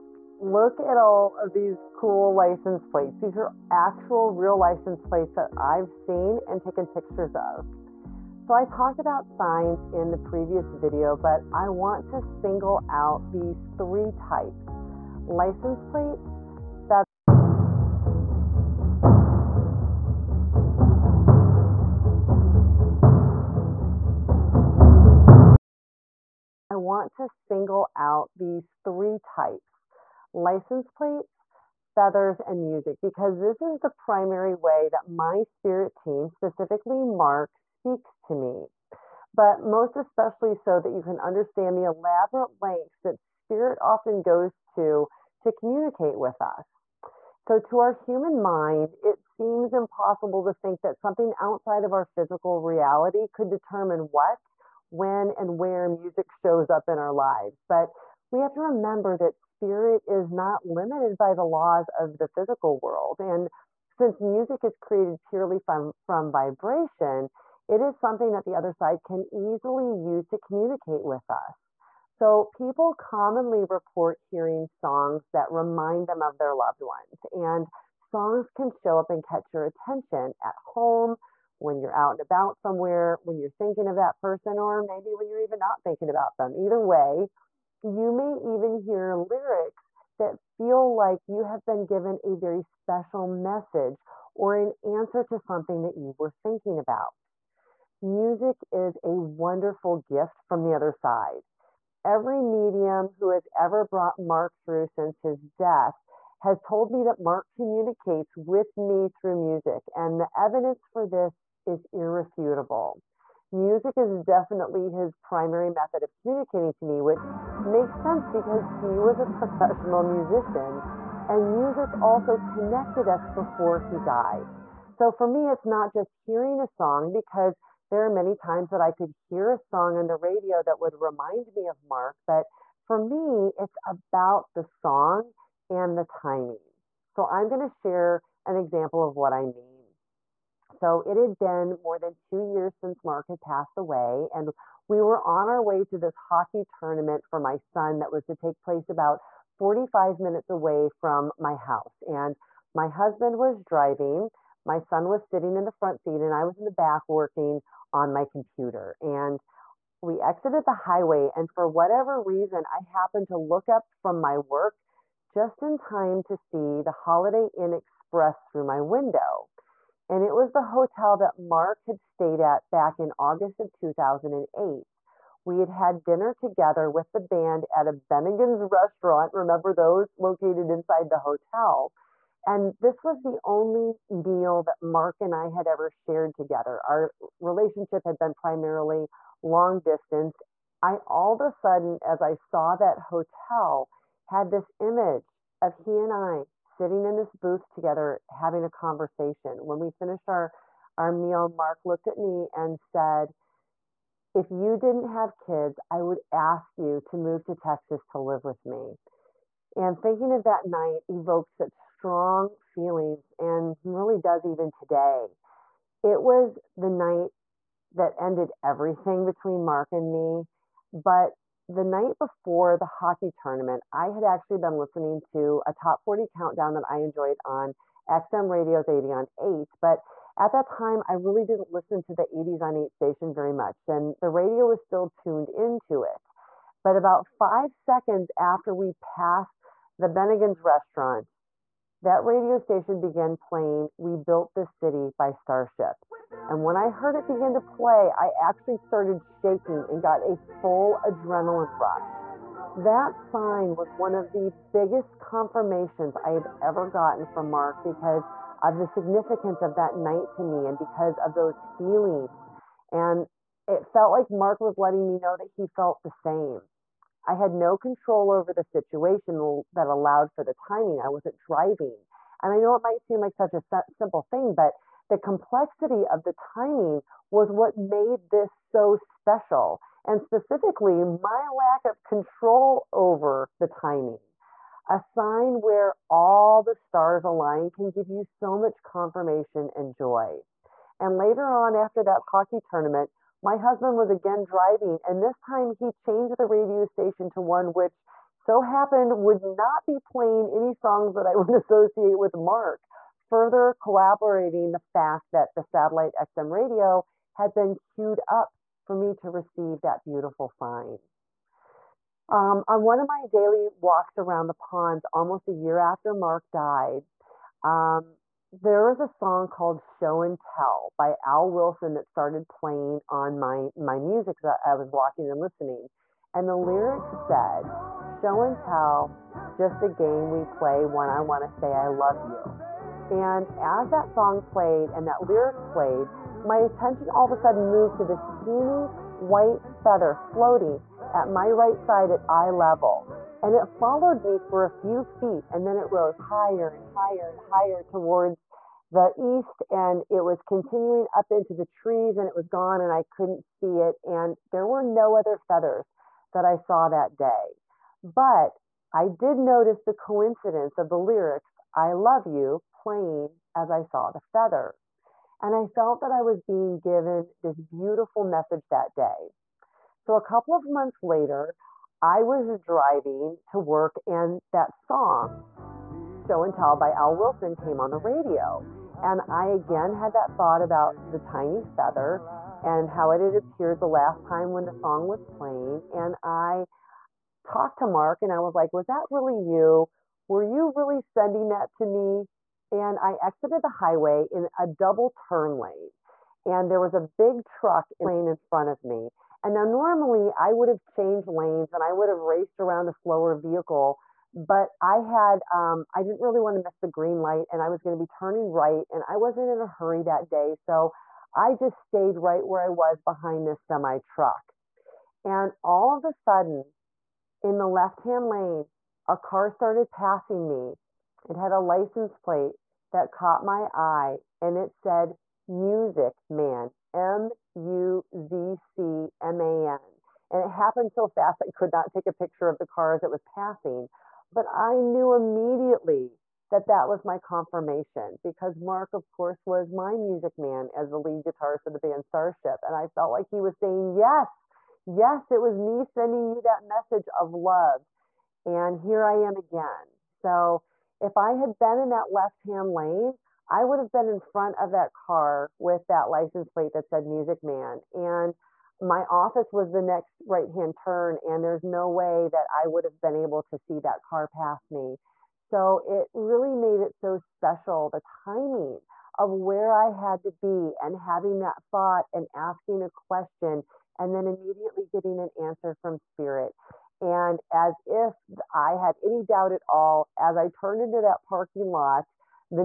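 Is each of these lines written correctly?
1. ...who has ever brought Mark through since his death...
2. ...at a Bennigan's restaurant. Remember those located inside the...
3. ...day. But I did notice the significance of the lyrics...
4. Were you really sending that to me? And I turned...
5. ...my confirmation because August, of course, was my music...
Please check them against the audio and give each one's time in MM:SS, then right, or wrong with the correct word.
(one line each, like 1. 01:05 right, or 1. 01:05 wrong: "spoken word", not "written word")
1. 01:43 right
2. 02:57 right
3. 05:57 wrong: "coincidence", not "significance"
4. 06:30 wrong: "exited", not "turned"
5. 07:17 wrong: "Mark", not "August".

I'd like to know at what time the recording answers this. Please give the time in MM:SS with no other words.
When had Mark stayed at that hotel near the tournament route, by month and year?
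02:53.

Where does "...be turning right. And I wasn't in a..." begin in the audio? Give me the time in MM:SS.
06:47.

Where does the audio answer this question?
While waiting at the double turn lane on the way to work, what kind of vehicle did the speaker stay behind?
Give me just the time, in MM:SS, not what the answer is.
06:53.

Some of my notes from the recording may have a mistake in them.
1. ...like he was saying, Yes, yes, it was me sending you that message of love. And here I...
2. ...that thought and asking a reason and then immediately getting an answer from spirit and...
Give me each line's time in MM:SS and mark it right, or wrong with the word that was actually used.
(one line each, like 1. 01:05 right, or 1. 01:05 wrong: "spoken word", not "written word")
1. 07:23 right
2. 07:51 wrong: "question", not "reason".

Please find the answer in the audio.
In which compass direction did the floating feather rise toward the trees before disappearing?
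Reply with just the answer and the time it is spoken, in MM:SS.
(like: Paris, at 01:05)
East, at 05:49.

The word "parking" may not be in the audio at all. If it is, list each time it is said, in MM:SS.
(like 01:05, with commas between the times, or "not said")
08:01.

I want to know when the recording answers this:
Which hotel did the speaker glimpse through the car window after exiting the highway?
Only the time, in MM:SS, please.
02:46.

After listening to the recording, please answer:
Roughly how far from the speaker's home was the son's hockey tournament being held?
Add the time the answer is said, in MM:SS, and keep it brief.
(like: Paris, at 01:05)
45 minutes, at 02:29.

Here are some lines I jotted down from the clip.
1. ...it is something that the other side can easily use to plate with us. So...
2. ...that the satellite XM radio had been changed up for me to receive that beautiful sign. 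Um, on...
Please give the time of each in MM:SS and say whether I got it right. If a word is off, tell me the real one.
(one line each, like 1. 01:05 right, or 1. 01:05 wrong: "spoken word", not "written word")
1. 01:07 wrong: "communicate", not "plate"
2. 05:05 wrong: "queued", not "changed".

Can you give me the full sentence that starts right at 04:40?
And specifically, my lack of control over the timing.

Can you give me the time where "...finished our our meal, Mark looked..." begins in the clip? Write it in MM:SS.
03:19.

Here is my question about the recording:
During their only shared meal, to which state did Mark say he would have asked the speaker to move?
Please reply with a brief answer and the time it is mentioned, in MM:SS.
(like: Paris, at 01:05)
Texas, at 03:27.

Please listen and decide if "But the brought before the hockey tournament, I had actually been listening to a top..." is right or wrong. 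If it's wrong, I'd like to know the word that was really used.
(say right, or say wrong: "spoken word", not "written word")
wrong: "night", not "brought".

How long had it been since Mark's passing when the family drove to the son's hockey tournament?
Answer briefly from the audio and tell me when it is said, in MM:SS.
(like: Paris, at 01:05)
More than two years, at 02:21.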